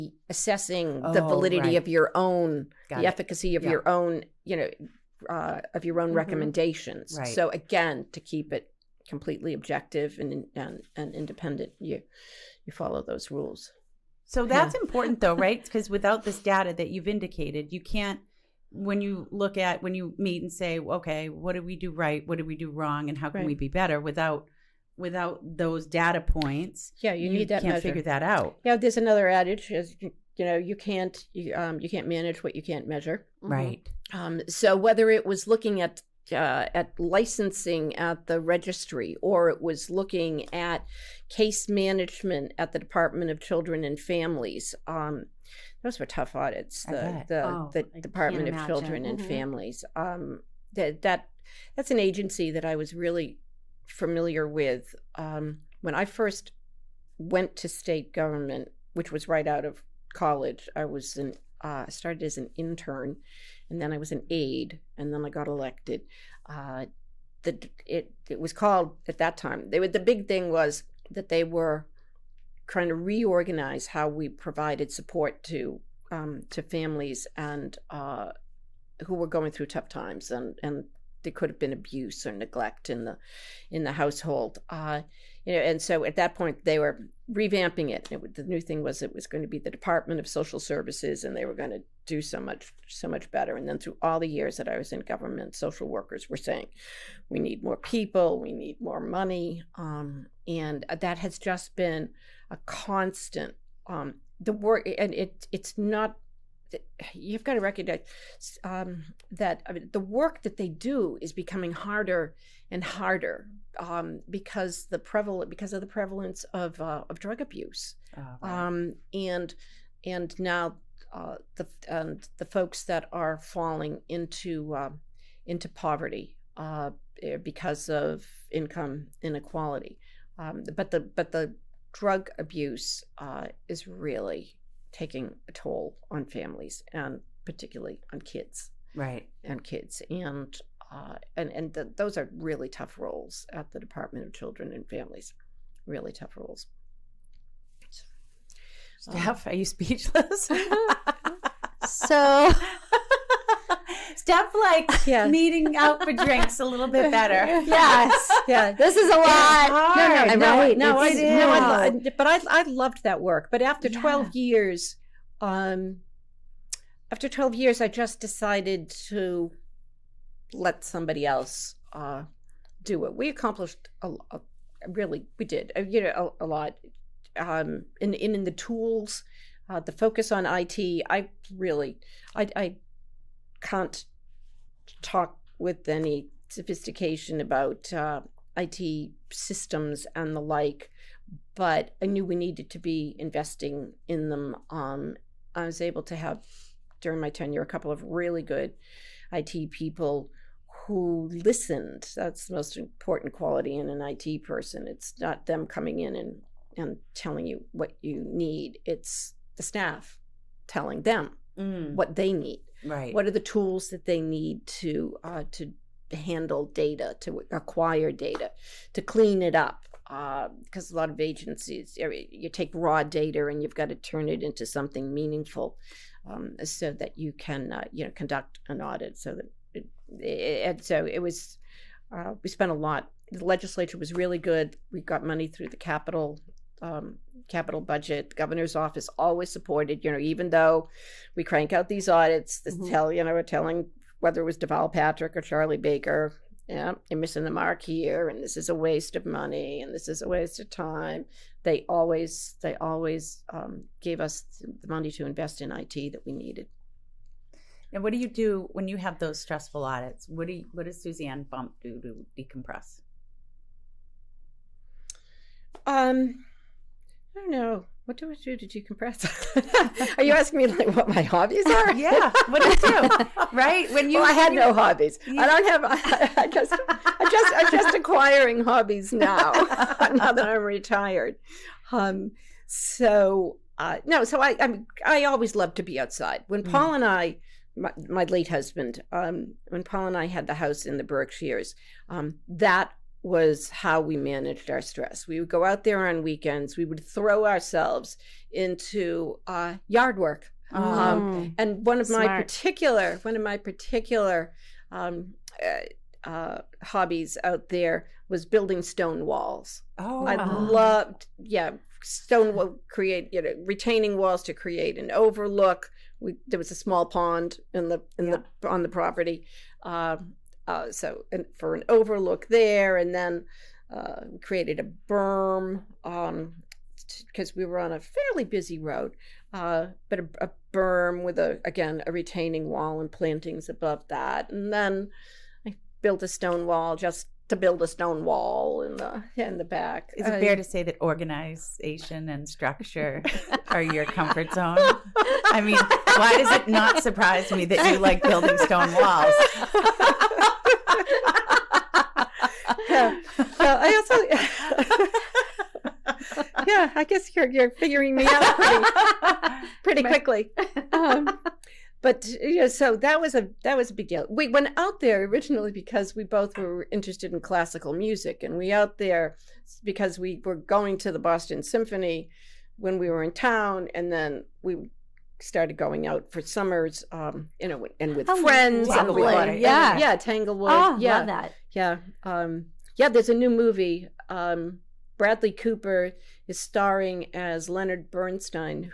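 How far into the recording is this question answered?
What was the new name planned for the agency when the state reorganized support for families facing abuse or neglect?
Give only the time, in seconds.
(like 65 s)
89 s.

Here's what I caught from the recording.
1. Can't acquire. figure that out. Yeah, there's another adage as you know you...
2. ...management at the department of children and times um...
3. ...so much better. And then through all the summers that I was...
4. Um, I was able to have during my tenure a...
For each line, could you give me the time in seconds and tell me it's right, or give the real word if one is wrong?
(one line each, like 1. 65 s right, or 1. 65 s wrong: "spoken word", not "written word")
1. 27 s wrong: "measure", not "acquire"
2. 41 s wrong: "families", not "times"
3. 92 s wrong: "years", not "summers"
4. 194 s right.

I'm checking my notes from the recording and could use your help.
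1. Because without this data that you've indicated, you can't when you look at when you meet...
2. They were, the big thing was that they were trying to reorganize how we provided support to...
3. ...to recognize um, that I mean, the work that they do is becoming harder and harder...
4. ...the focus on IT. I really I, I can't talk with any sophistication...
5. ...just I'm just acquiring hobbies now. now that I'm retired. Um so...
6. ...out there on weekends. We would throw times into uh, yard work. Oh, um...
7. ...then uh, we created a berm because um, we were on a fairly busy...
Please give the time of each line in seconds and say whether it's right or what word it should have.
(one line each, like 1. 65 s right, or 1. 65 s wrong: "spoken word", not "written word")
1. 15 s right
2. 69 s right
3. 107 s right
4. 179 s right
5. 277 s right
6. 295 s wrong: "ourselves", not "times"
7. 323 s right.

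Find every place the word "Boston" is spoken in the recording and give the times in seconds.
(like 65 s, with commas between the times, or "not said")
371 s.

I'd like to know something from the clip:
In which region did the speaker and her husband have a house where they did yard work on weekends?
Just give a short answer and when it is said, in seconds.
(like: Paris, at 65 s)
The Berkshires, at 291 s.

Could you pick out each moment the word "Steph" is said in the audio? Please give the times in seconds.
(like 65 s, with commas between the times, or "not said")
149 s, 154 s.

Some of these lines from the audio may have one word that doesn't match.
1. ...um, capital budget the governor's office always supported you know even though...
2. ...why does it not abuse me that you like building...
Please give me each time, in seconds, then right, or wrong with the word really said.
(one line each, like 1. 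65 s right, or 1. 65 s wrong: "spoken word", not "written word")
1. 236 s right
2. 346 s wrong: "surprise", not "abuse".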